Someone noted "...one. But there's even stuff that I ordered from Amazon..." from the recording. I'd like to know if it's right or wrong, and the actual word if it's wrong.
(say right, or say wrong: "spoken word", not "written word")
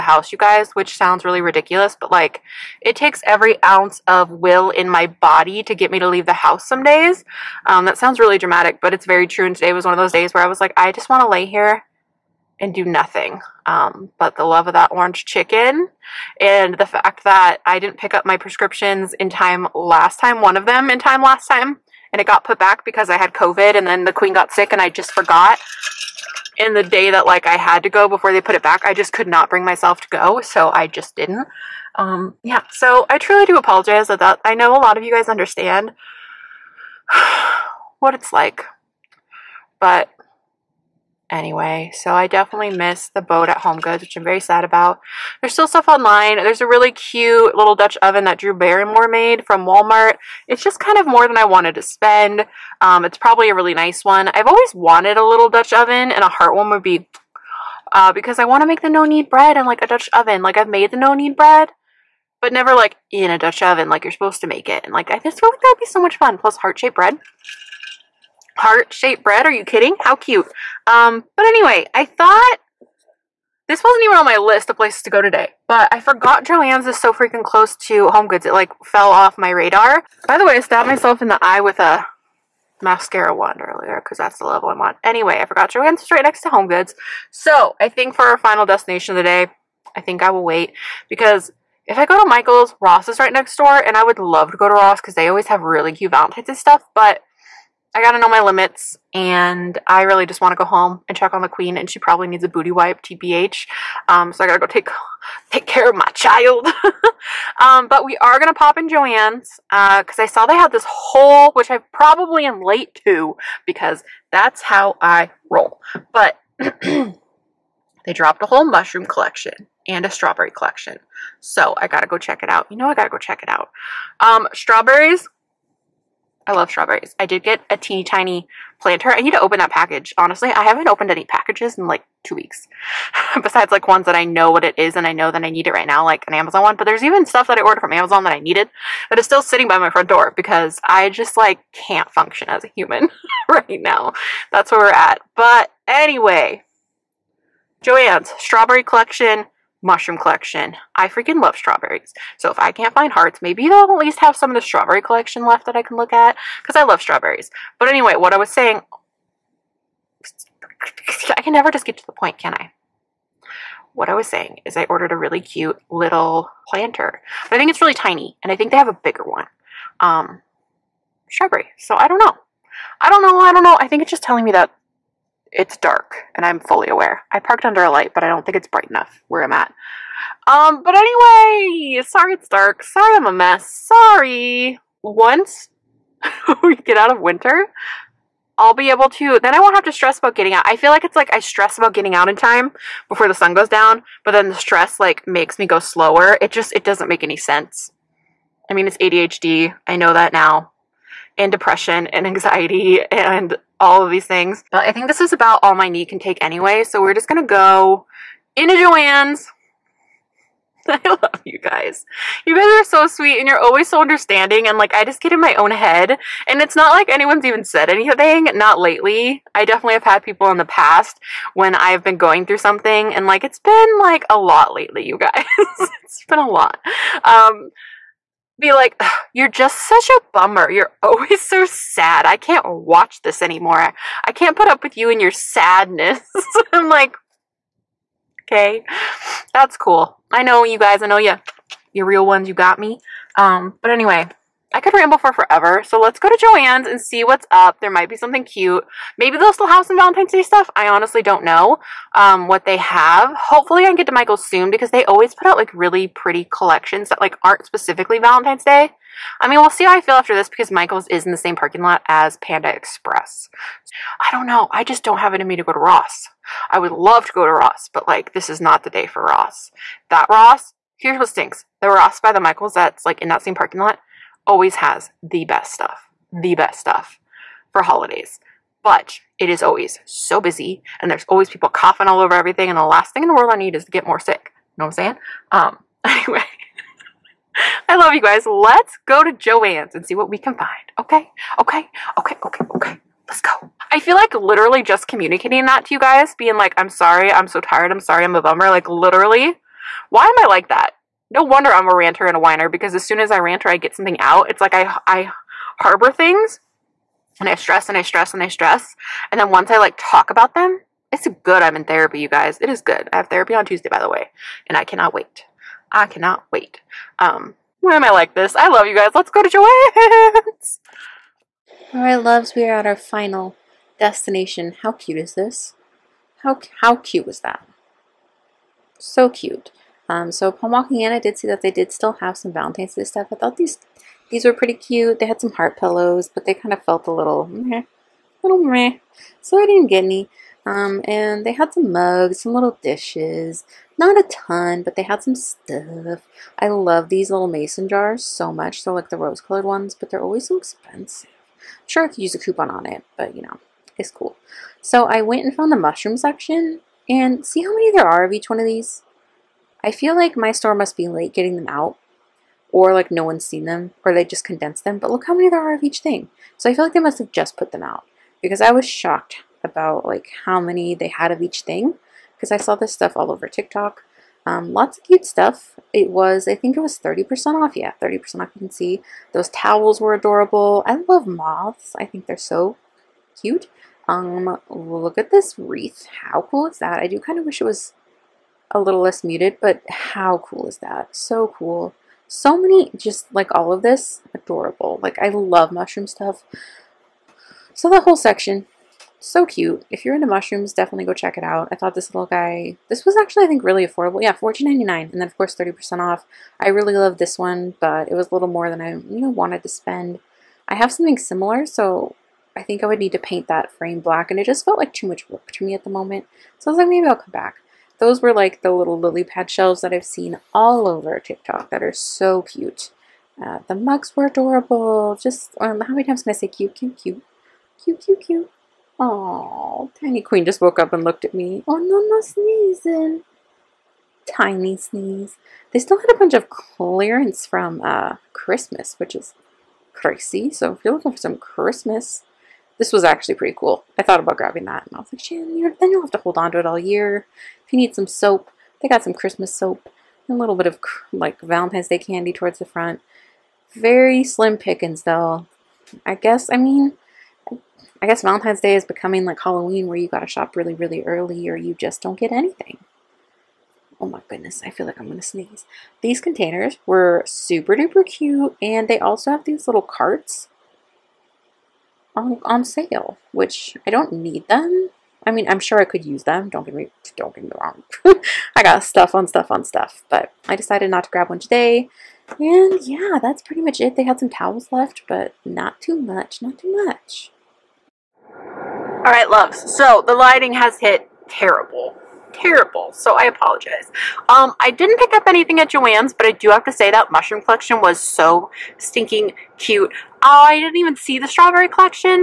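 right.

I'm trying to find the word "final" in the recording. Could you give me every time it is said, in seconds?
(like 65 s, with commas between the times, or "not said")
88 s, 322 s.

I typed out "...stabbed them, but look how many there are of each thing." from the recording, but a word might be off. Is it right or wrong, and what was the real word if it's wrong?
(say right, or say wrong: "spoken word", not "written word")
wrong: "condensed", not "stabbed".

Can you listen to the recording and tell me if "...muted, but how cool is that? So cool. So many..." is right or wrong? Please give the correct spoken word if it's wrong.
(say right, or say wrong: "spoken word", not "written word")
right.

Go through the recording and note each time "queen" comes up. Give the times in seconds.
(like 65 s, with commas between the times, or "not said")
24 s, 101 s, 430 s.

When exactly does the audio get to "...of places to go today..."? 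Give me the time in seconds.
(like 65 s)
74 s.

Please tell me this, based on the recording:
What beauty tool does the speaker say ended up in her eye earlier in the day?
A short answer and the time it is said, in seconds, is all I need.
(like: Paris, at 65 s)
mascara wand, at 82 s.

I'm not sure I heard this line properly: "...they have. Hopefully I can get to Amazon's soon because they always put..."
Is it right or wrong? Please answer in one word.
wrong.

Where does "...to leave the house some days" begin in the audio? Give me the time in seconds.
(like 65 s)
5 s.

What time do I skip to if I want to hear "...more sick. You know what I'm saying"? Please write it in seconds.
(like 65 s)
284 s.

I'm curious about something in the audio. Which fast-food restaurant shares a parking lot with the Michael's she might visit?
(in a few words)
Panda Express.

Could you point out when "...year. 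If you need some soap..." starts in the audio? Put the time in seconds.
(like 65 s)
446 s.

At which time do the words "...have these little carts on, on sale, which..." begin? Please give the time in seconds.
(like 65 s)
469 s.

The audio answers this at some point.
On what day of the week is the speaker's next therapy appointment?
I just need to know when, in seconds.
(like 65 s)
313 s.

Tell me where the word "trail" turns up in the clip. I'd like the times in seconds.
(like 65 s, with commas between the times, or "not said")
not said.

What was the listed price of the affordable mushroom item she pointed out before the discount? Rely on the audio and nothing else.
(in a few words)
$14.99.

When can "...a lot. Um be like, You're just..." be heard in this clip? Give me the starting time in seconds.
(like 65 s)
226 s.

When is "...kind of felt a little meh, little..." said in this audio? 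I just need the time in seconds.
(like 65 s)
336 s.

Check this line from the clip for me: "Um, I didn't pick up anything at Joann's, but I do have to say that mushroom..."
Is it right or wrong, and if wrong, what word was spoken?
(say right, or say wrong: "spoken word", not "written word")
right.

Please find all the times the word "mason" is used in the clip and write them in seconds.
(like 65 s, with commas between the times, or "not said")
347 s.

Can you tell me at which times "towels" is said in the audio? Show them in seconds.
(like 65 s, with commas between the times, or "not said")
379 s, 484 s.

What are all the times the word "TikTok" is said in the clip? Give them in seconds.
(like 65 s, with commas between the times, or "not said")
373 s, 421 s.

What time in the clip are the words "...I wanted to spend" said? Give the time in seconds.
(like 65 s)
51 s.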